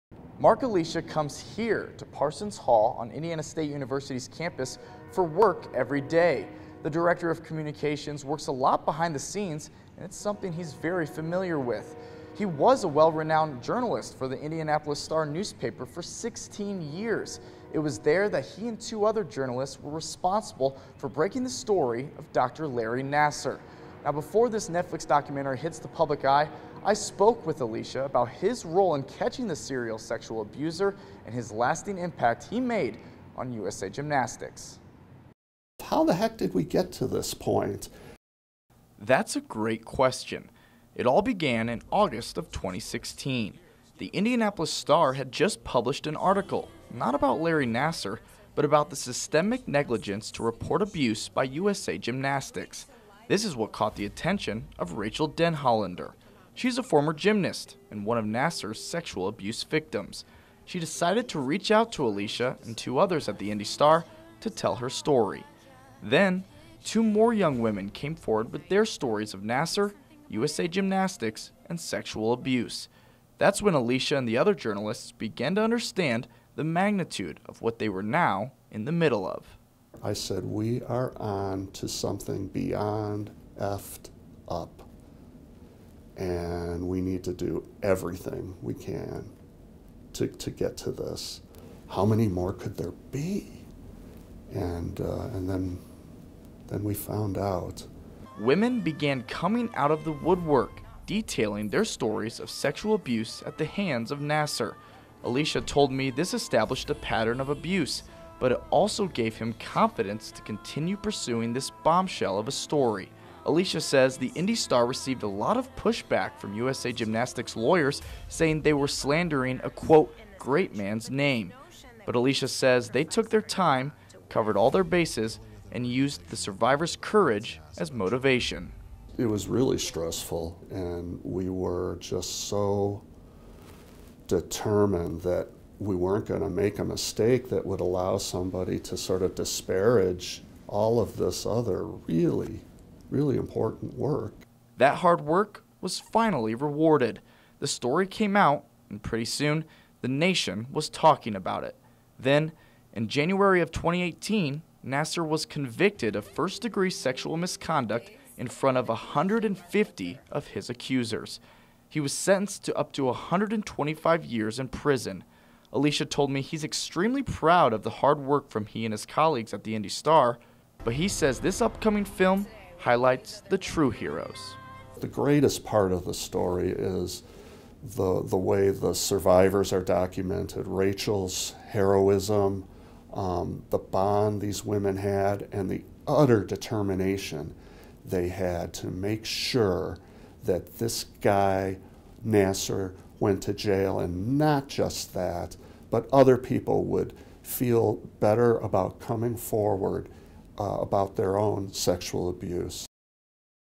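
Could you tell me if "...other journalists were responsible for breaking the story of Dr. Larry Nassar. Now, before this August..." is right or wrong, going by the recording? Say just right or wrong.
wrong.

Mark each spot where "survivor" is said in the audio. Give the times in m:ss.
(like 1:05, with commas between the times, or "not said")
2:06, 2:58.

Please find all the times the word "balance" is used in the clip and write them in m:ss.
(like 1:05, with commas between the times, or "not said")
not said.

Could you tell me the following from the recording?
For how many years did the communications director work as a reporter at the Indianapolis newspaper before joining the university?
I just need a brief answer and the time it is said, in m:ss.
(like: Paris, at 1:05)
16, at 0:16.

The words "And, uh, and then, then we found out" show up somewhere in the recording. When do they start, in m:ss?
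1:34.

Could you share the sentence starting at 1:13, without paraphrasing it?
That's when Alesia and the other journalists began to understand the magnitude of what they were now in the middle of.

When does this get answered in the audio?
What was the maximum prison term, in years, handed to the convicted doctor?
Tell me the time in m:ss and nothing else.
2:43.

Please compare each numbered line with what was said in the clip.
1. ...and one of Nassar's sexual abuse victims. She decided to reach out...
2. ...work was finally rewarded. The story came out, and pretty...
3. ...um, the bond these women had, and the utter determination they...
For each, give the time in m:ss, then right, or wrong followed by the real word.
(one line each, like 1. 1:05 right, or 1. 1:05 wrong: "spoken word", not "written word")
1. 0:57 right
2. 2:25 right
3. 3:03 right.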